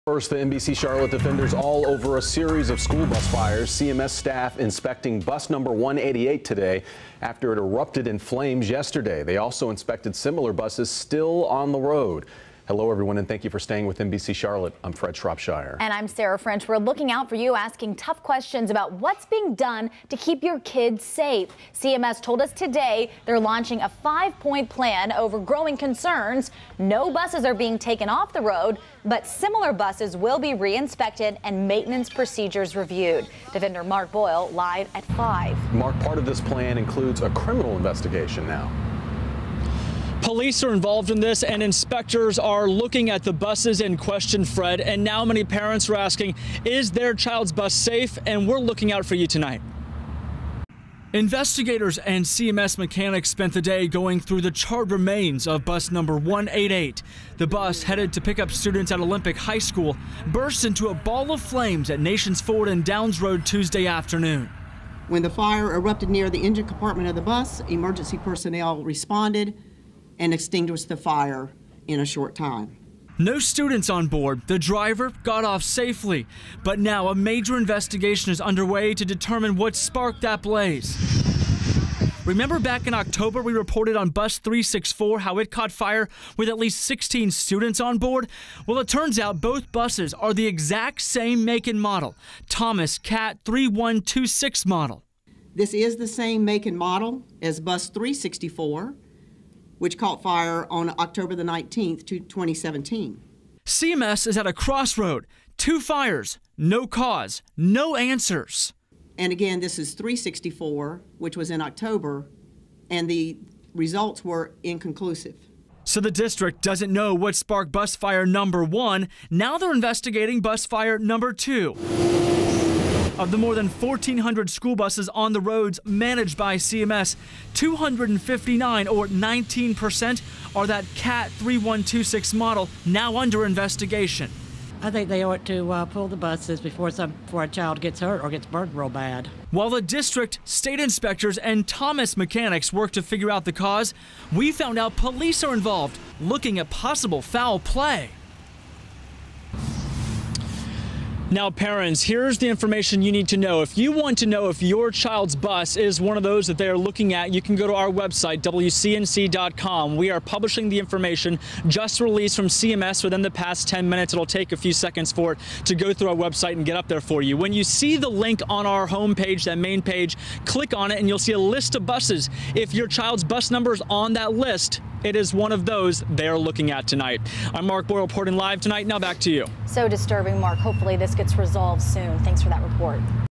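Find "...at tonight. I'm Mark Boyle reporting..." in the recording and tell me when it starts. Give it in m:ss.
2:56.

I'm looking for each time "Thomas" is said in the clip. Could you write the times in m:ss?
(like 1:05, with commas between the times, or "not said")
1:32, 2:21.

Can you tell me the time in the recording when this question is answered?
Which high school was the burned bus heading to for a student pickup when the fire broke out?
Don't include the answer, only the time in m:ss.
0:58.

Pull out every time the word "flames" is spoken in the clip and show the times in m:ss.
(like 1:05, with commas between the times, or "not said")
0:08, 1:01.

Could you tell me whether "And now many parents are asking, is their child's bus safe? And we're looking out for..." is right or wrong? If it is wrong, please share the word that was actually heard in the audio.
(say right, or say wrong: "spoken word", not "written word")
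right.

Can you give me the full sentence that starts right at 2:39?
We are publishing the information just released from CMS within the past 10 minutes.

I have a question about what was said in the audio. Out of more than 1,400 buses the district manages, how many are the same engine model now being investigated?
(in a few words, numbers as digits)
259.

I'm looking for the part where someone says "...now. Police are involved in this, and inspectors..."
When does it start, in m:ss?
0:38.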